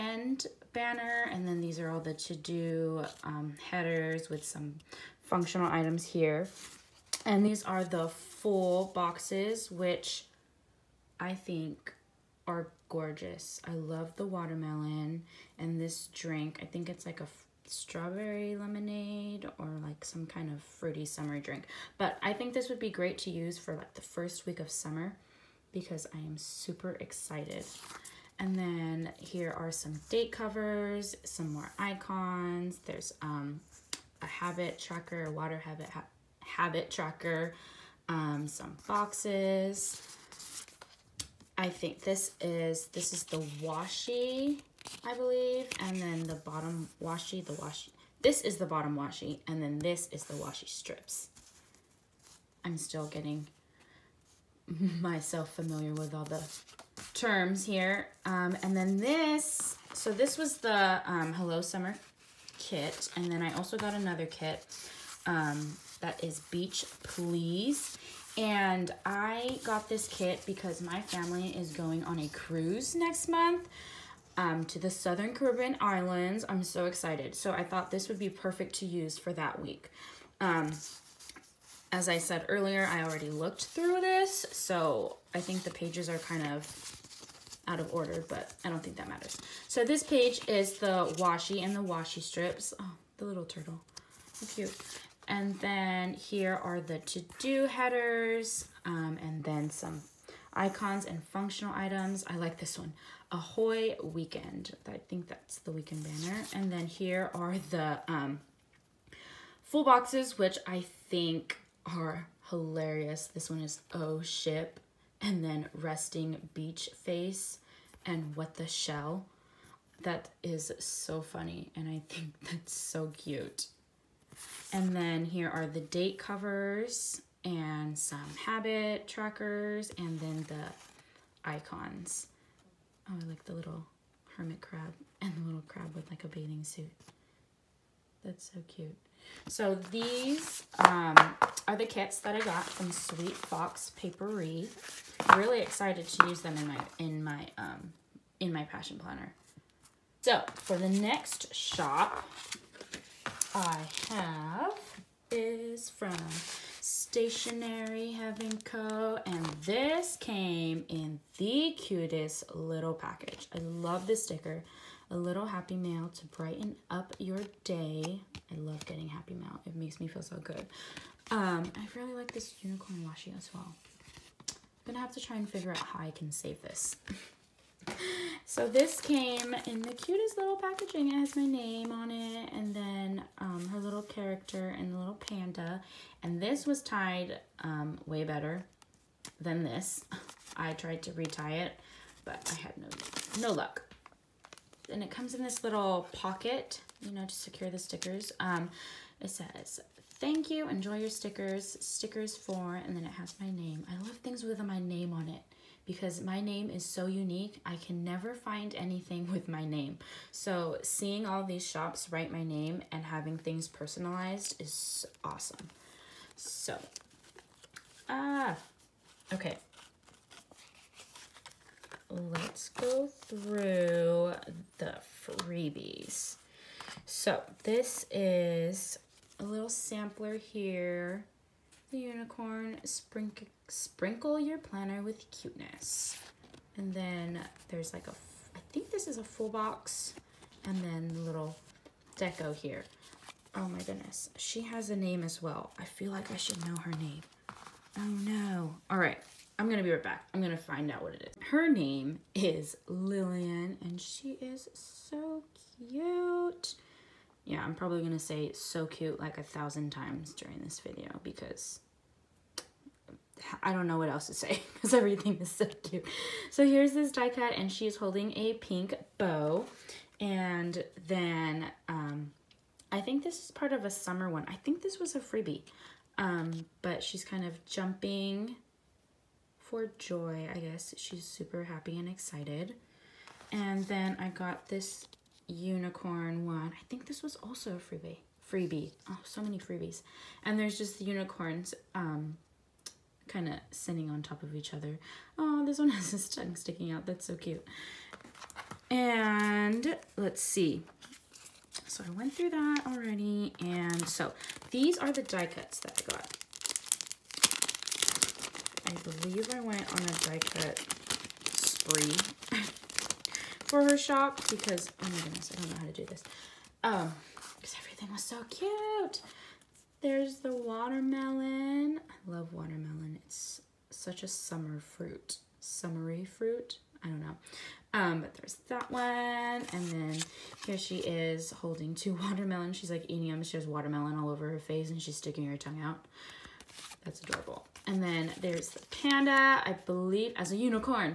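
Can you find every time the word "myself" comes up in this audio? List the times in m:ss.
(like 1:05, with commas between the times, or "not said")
0:55.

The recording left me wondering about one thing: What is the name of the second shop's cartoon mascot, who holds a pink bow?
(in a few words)
Lillian.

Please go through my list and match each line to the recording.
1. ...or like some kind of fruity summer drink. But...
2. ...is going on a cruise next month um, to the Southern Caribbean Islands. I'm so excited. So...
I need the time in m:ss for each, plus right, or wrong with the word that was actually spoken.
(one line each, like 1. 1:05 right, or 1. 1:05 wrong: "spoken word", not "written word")
1. 0:19 right
2. 1:11 right.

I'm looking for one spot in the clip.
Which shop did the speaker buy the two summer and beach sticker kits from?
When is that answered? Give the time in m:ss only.
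2:22.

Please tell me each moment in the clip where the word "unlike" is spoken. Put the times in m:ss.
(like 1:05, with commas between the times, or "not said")
not said.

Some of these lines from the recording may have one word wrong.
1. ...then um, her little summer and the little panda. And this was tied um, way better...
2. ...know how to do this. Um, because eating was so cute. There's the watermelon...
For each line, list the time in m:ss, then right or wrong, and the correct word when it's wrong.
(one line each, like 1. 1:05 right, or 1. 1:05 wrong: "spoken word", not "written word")
1. 3:02 wrong: "character", not "summer"
2. 5:15 wrong: "everything", not "eating".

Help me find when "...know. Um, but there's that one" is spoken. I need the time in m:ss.
5:27.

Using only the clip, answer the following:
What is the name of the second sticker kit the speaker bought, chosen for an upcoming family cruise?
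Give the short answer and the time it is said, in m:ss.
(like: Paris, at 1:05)
Beach Please, at 1:06.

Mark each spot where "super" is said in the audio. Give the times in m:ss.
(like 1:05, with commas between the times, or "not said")
0:26, 4:41.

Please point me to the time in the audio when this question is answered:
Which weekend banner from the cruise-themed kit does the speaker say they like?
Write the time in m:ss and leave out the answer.
1:43.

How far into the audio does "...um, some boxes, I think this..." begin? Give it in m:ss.
0:38.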